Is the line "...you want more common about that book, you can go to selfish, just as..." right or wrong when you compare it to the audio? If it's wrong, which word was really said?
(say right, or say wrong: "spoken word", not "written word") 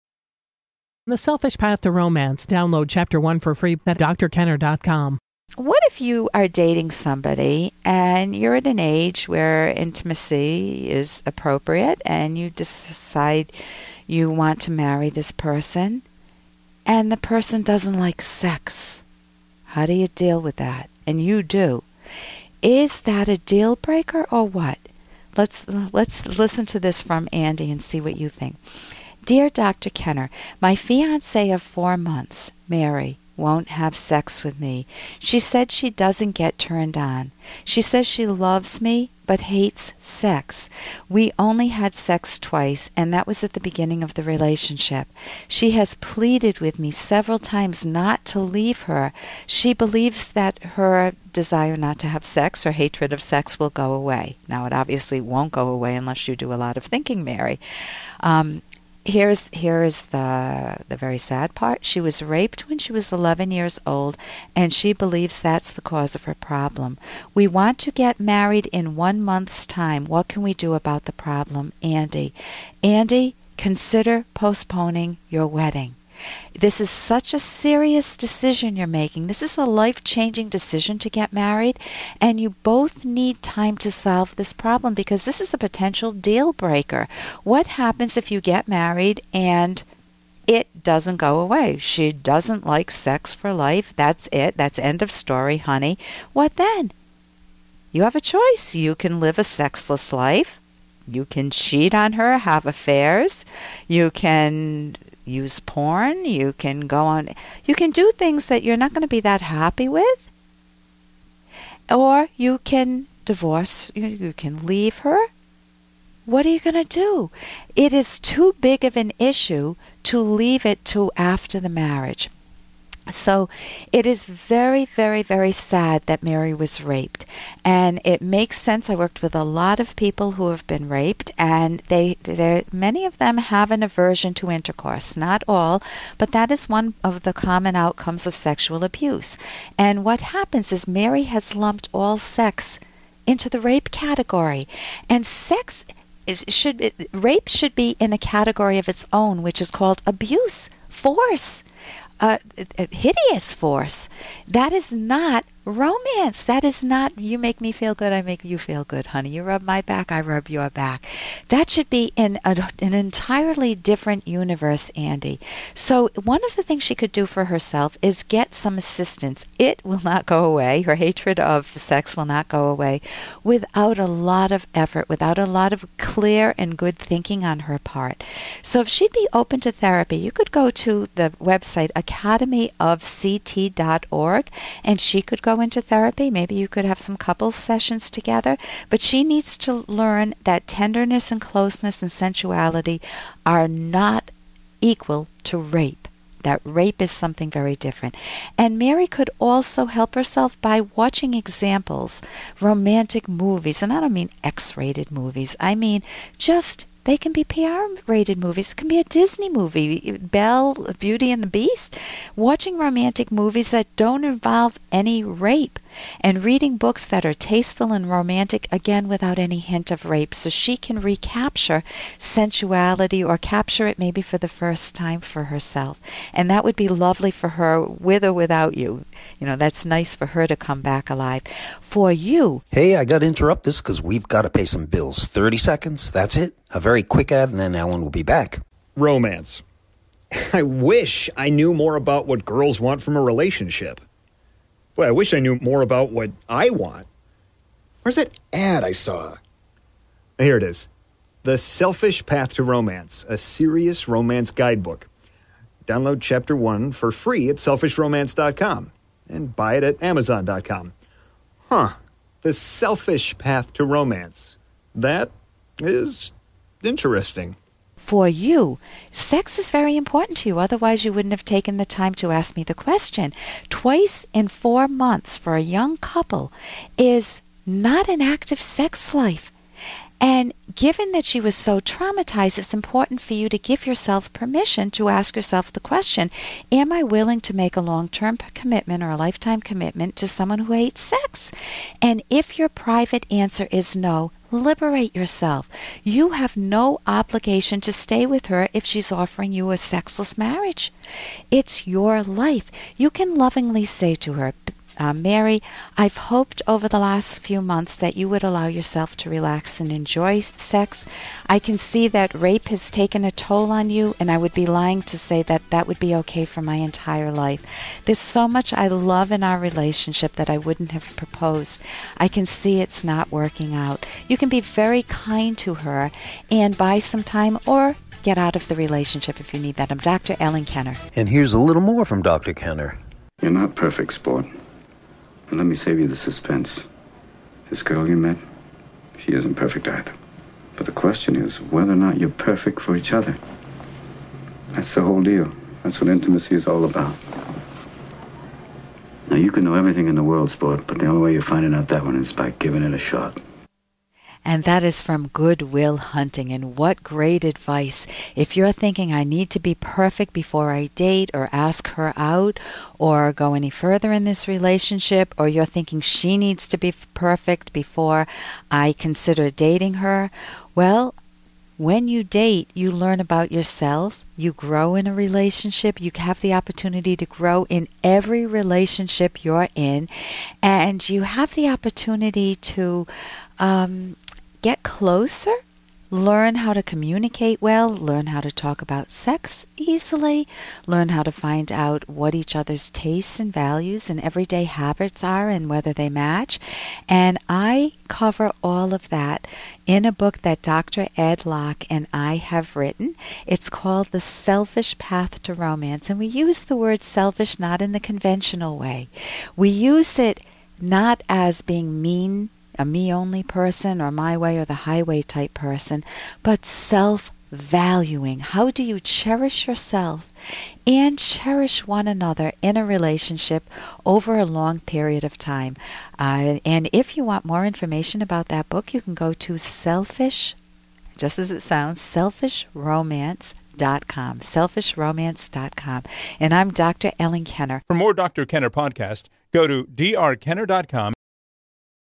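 wrong: "information", not "common".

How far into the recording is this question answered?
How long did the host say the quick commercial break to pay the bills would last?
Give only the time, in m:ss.
3:55.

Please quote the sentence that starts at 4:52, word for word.
And if your private answer is no, Liberate yourself.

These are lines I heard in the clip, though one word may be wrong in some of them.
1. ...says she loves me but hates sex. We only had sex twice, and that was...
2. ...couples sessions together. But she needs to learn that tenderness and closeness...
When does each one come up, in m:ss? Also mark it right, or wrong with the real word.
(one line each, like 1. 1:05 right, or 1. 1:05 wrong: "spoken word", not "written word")
1. 0:37 right
2. 3:07 right.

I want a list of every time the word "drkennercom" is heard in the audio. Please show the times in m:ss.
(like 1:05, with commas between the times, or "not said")
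0:03, 7:19.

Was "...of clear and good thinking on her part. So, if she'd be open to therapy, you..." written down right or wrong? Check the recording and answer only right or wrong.
right.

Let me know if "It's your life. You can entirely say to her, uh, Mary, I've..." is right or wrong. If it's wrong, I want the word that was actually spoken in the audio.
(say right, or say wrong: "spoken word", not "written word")
wrong: "lovingly", not "entirely".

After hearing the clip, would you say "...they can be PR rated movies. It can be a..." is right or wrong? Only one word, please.
right.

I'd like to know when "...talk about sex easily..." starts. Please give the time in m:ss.
6:28.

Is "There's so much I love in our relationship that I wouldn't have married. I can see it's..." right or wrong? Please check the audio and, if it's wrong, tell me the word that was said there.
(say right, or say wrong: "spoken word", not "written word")
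wrong: "proposed", not "married".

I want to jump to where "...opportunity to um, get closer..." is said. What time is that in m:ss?
6:21.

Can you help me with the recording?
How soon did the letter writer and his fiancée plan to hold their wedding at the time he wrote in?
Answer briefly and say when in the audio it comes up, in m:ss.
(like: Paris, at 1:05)
one month, at 1:08.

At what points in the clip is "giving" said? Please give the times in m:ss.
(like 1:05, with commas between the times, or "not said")
5:52.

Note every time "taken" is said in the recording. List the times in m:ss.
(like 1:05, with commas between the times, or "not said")
4:31, 5:12.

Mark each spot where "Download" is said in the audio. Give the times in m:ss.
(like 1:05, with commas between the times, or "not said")
0:02, 4:15.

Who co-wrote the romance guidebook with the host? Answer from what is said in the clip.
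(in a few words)
Dr. Ed Locke.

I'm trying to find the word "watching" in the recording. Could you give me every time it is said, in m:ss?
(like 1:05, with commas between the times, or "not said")
3:20, 3:32.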